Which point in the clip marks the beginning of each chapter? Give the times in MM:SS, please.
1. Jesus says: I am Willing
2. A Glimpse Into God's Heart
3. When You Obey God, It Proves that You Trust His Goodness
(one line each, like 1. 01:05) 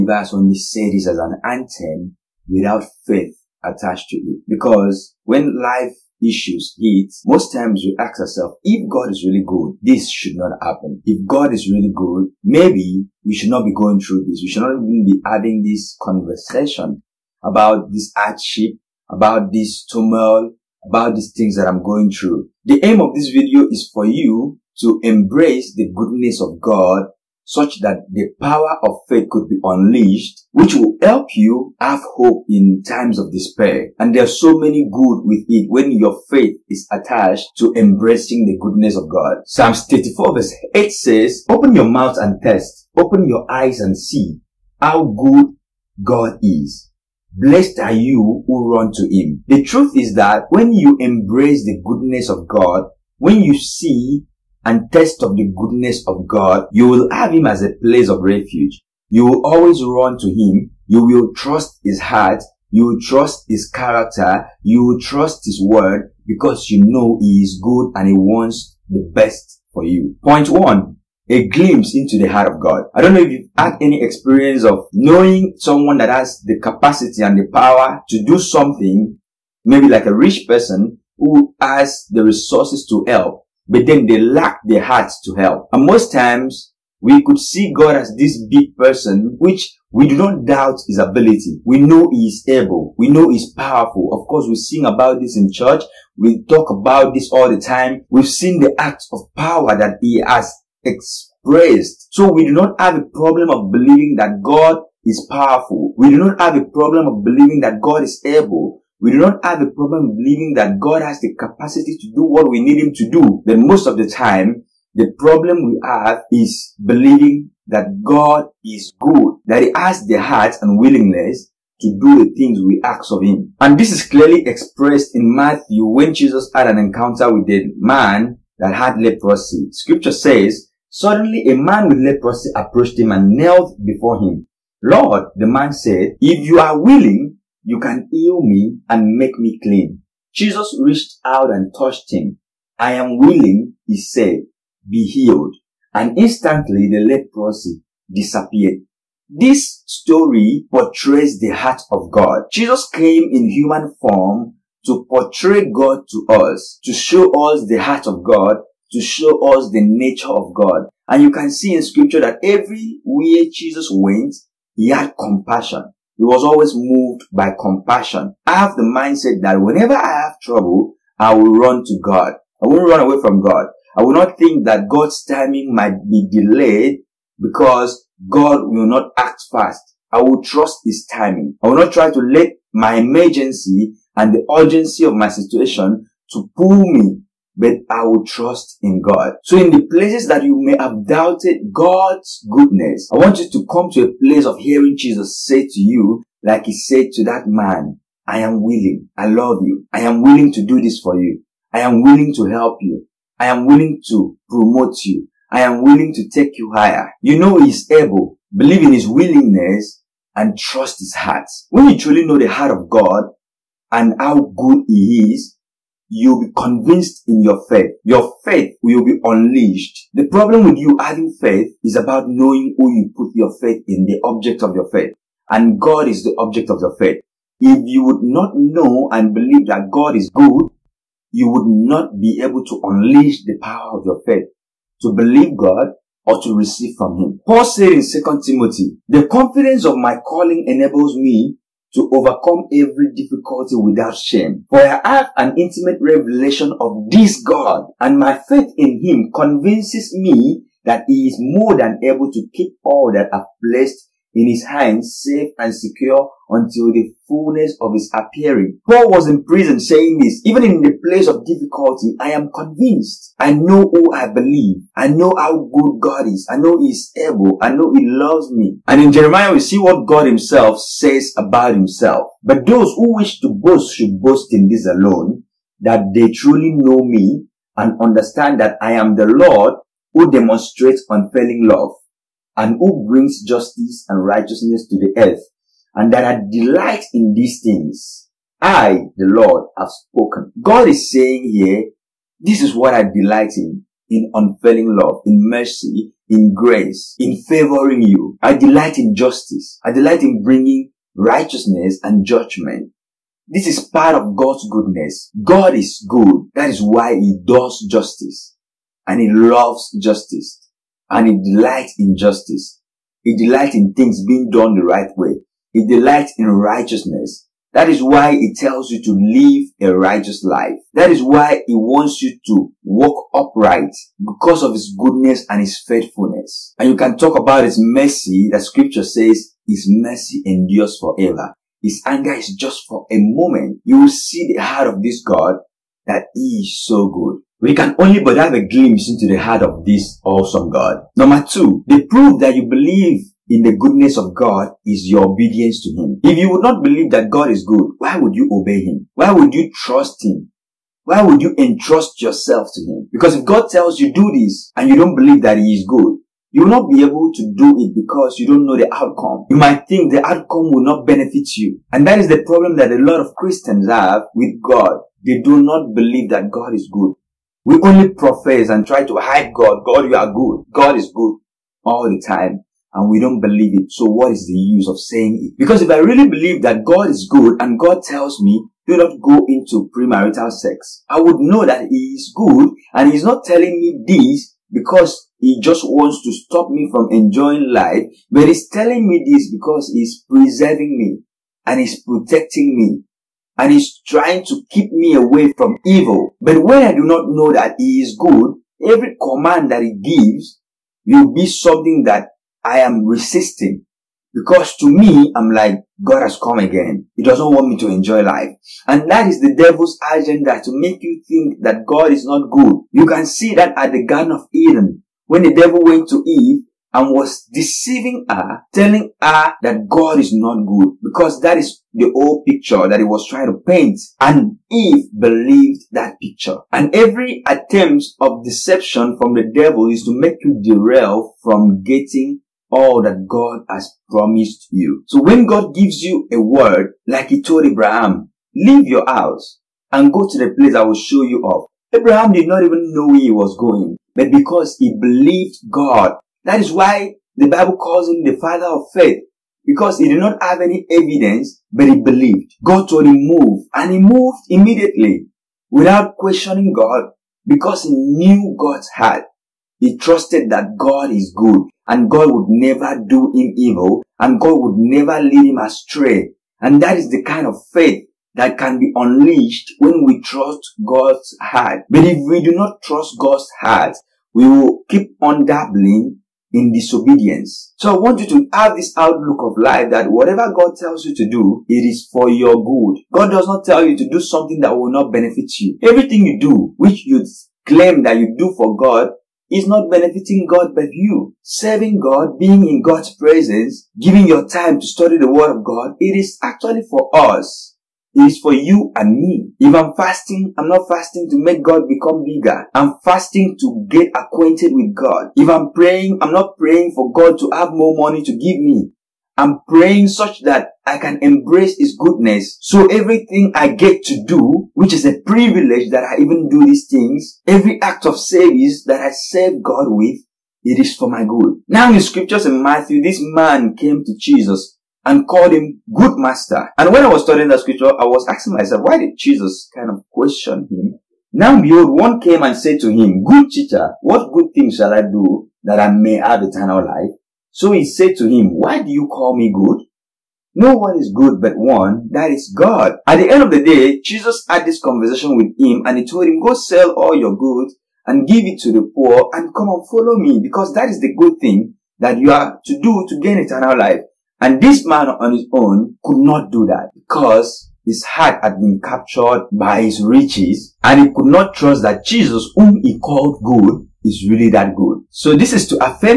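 1. 03:07
2. 01:09
3. 05:40.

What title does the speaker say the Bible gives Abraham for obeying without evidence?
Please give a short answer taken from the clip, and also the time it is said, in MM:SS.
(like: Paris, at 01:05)
Father of faith, at 07:28.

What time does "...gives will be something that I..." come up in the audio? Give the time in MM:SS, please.
06:39.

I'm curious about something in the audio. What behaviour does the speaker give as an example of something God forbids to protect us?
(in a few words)
Premarital sex.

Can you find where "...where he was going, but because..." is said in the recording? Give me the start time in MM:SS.
07:23.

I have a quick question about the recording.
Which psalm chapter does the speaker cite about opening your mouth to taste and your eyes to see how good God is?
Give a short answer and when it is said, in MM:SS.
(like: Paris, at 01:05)
Psalms 34, at 00:39.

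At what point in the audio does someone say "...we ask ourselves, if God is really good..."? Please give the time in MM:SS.
00:07.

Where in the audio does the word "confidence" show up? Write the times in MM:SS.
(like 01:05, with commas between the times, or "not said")
03:59.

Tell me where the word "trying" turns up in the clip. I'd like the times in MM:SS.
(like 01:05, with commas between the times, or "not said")
06:34, 07:03.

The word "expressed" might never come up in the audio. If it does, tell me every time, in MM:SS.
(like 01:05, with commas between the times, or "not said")
01:40, 02:04.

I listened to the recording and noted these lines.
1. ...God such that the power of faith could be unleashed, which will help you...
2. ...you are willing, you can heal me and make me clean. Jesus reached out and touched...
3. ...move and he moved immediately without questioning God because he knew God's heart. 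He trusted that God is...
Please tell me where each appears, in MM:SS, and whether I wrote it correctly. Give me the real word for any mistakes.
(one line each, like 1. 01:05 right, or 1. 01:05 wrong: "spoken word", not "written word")
1. 00:26 right
2. 02:16 right
3. 07:33 right.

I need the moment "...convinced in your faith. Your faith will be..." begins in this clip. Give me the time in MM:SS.
03:36.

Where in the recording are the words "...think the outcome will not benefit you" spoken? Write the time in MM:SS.
05:59.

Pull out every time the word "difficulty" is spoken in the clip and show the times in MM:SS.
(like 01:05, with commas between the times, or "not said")
04:03, 04:21.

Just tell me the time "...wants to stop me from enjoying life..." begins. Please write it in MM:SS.
06:25.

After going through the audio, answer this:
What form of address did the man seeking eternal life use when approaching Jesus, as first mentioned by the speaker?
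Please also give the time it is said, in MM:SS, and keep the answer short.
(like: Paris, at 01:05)
Good master, at 08:45.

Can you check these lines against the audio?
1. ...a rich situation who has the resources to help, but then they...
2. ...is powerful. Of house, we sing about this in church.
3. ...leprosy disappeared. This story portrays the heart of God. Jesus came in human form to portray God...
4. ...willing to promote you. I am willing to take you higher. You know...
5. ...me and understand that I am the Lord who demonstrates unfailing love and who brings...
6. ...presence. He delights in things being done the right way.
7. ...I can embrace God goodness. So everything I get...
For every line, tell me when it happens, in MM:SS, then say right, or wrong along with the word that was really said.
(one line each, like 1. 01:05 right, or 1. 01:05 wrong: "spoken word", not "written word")
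1. 01:20 wrong: "person", not "situation"
2. 01:33 wrong: "course", not "house"
3. 02:26 right
4. 03:23 right
5. 04:37 right
6. 05:12 wrong: "justice", not "presence"
7. 08:30 wrong: "His", not "God".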